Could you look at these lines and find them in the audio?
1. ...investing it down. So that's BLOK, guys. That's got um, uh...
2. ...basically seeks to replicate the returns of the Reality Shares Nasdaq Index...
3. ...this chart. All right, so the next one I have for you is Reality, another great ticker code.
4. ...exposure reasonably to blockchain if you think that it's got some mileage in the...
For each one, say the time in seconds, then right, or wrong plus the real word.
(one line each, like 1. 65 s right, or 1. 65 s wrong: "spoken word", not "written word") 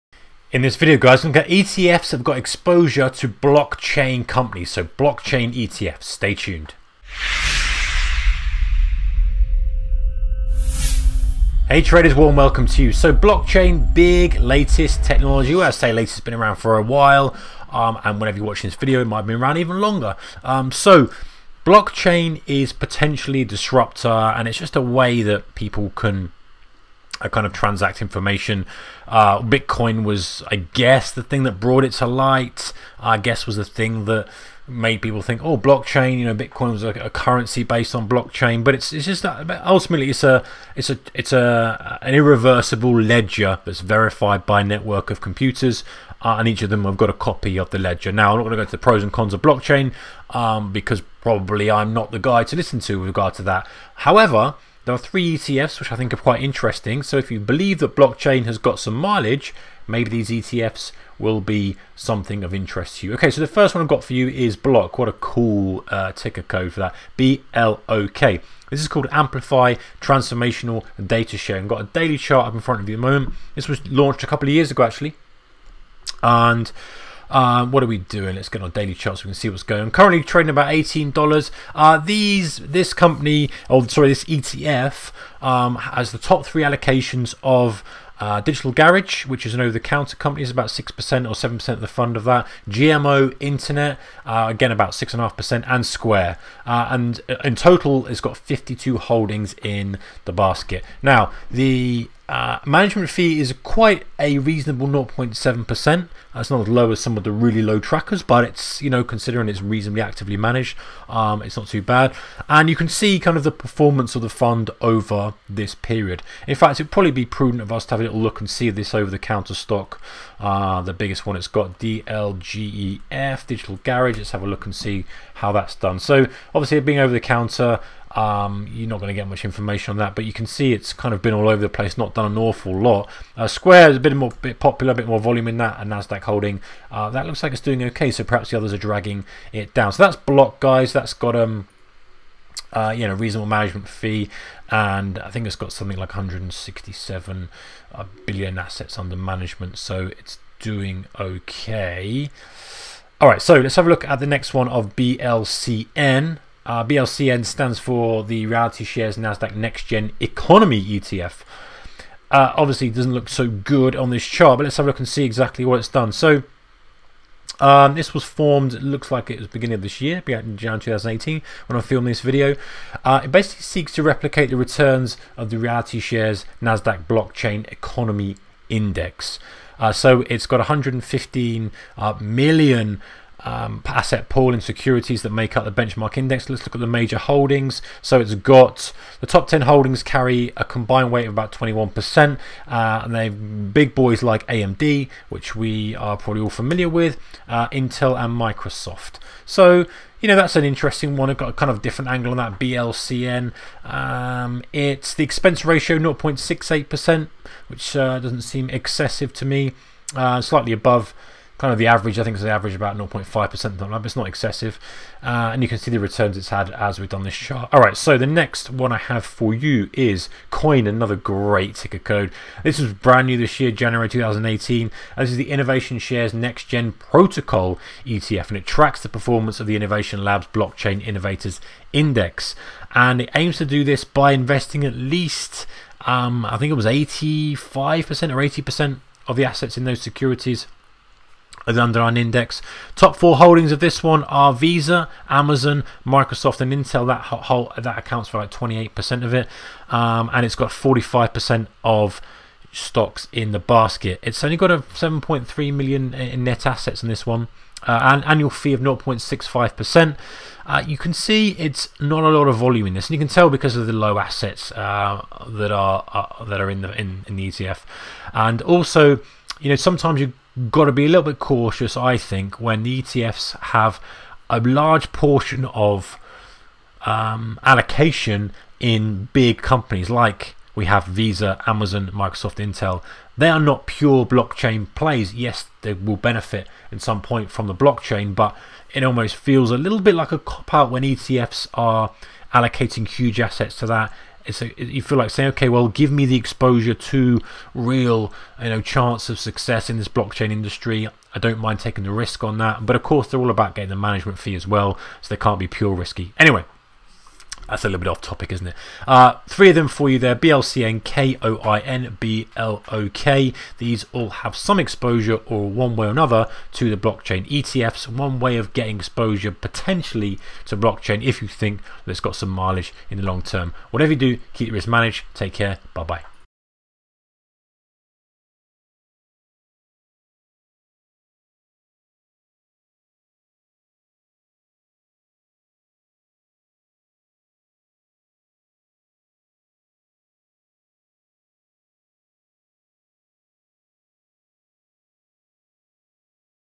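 1. 138 s wrong: "dragging", not "investing"
2. 173 s wrong: "Blockchain", not "Index"
3. 217 s wrong: "KOIN", not "Reality"
4. 318 s wrong: "potentially", not "reasonably".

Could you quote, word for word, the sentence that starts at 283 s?
They are not pure blockchain plays.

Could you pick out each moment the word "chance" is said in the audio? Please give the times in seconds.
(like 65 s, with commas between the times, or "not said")
298 s.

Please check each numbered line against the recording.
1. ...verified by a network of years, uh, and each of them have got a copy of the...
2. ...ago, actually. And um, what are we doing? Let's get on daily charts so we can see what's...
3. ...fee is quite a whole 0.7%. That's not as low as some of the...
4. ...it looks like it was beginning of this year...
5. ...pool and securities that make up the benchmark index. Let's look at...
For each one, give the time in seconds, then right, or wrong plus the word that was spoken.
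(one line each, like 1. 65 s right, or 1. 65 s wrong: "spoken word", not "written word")
1. 43 s wrong: "computers", not "years"
2. 74 s right
3. 103 s wrong: "reasonable", not "whole"
4. 168 s right
5. 184 s right.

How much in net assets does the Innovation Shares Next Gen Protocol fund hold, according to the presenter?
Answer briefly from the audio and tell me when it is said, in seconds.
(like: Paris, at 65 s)
7.3 million, at 254 s.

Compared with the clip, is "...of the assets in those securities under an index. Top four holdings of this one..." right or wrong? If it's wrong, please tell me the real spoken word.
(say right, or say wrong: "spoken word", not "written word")
right.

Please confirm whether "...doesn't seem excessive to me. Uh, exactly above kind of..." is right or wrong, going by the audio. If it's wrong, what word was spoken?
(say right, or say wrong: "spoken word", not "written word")
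wrong: "slightly", not "exactly".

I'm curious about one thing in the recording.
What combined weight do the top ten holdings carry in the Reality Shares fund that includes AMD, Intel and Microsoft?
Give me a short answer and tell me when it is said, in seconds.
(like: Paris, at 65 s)
About 21%, at 191 s.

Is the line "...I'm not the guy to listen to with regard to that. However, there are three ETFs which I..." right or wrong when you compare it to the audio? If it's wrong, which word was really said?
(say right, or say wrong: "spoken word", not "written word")
right.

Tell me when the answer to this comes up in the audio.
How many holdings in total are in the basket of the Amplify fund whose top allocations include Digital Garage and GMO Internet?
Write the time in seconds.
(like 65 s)
98 s.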